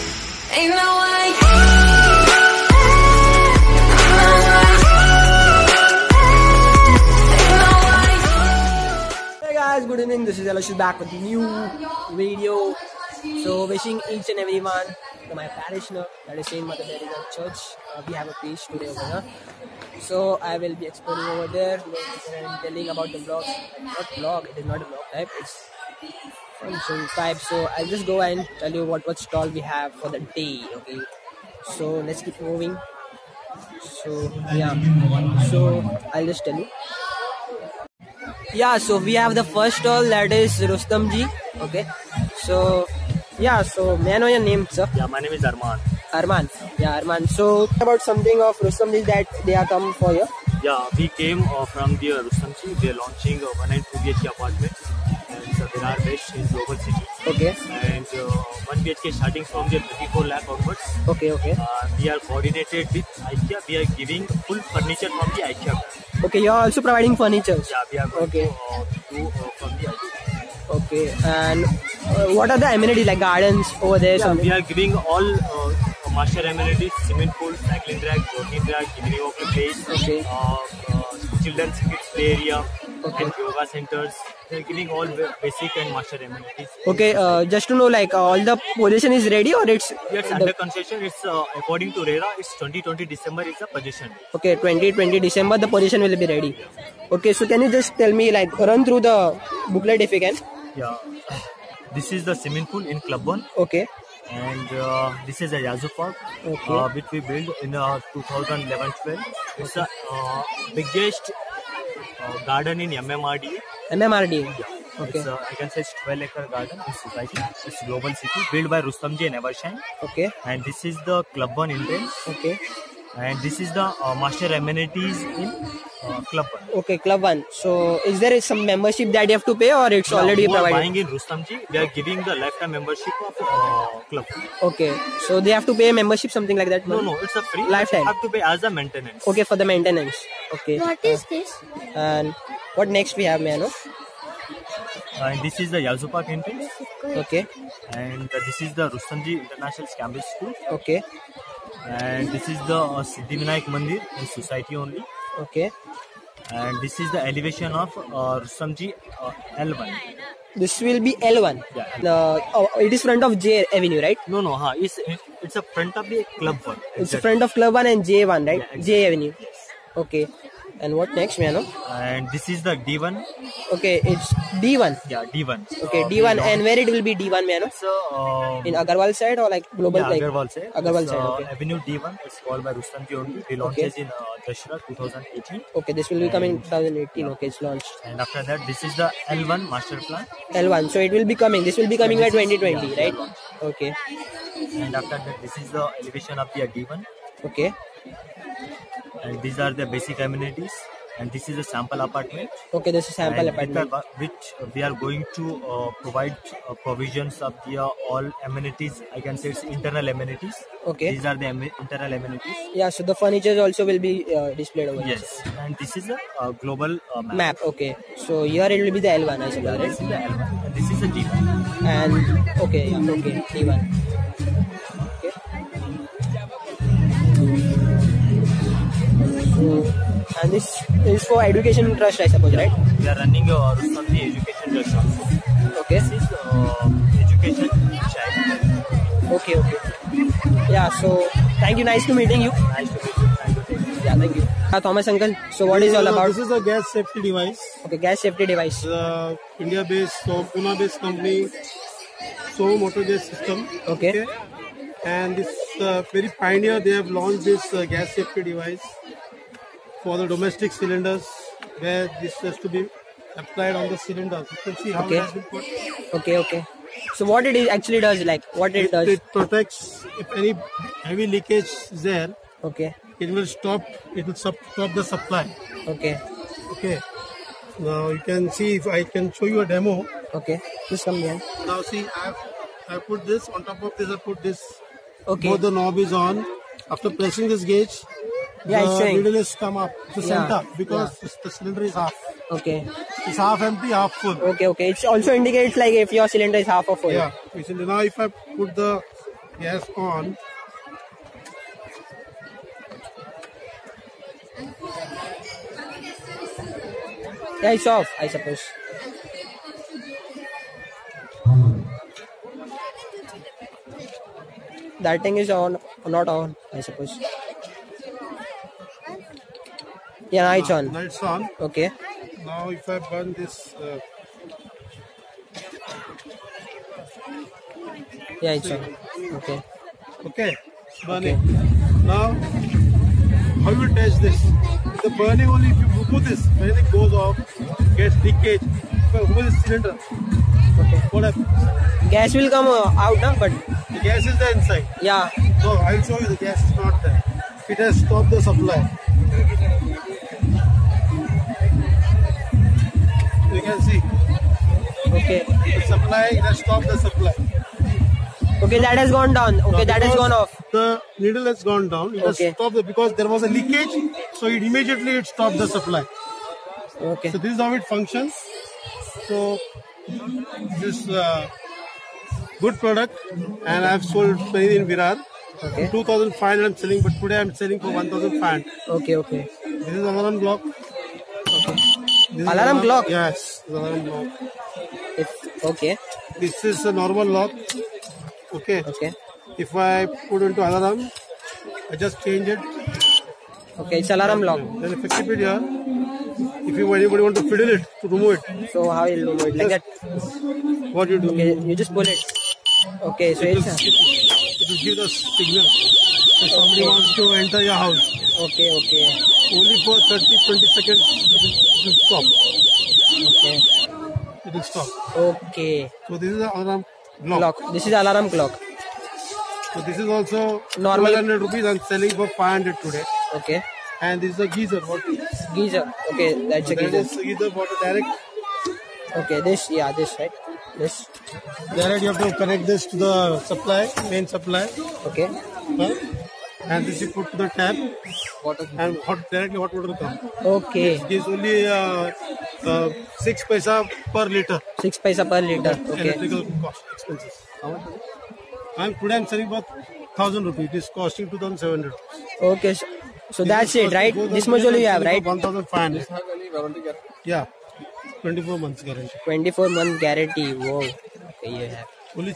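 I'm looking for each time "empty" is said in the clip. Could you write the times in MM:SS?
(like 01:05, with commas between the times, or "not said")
04:53.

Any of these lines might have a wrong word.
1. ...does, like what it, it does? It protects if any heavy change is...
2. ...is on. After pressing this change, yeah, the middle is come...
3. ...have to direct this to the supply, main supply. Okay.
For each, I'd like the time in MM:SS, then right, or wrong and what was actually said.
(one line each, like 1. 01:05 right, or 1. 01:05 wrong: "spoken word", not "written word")
1. 04:27 wrong: "leakage", not "change"
2. 04:45 wrong: "gauge", not "change"
3. 07:12 wrong: "connect", not "direct".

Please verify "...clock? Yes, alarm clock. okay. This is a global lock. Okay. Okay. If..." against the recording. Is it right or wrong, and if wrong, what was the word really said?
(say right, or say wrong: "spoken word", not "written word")
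wrong: "normal", not "global".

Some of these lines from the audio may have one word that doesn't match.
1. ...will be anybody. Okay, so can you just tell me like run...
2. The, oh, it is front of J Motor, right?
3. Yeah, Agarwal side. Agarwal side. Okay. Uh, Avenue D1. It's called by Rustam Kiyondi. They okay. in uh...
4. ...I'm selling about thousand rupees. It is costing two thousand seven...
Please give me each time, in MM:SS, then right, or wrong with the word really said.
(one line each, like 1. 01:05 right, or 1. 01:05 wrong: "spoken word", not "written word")
1. 01:36 wrong: "ready", not "anybody"
2. 02:42 wrong: "Avenue", not "Motor"
3. 02:59 right
4. 07:29 right.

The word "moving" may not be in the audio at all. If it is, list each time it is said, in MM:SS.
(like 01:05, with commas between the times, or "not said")
00:32.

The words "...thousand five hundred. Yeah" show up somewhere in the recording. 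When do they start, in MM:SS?
07:35.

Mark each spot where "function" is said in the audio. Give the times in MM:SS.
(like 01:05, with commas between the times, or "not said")
00:26, 06:07.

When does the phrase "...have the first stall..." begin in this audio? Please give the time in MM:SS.
00:39.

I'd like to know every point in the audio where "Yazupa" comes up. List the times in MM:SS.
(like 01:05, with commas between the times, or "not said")
02:25.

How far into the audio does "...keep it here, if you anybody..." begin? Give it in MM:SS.
06:35.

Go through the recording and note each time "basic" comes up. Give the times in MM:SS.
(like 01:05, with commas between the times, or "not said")
01:25, 03:19.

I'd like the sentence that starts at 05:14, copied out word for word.
That thing is on, not on, I suppose.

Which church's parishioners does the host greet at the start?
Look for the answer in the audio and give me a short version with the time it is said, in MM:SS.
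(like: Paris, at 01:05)
Saint Mother Teresa Church, at 00:16.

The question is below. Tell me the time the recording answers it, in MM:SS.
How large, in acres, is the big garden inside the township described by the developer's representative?
01:56.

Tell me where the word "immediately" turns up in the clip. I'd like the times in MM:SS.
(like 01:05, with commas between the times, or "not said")
06:04.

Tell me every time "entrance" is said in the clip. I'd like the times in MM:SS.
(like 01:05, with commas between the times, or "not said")
02:01, 02:26.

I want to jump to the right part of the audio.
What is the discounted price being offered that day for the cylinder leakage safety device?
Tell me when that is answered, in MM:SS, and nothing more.
06:17.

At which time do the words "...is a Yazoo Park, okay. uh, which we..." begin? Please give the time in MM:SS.
01:45.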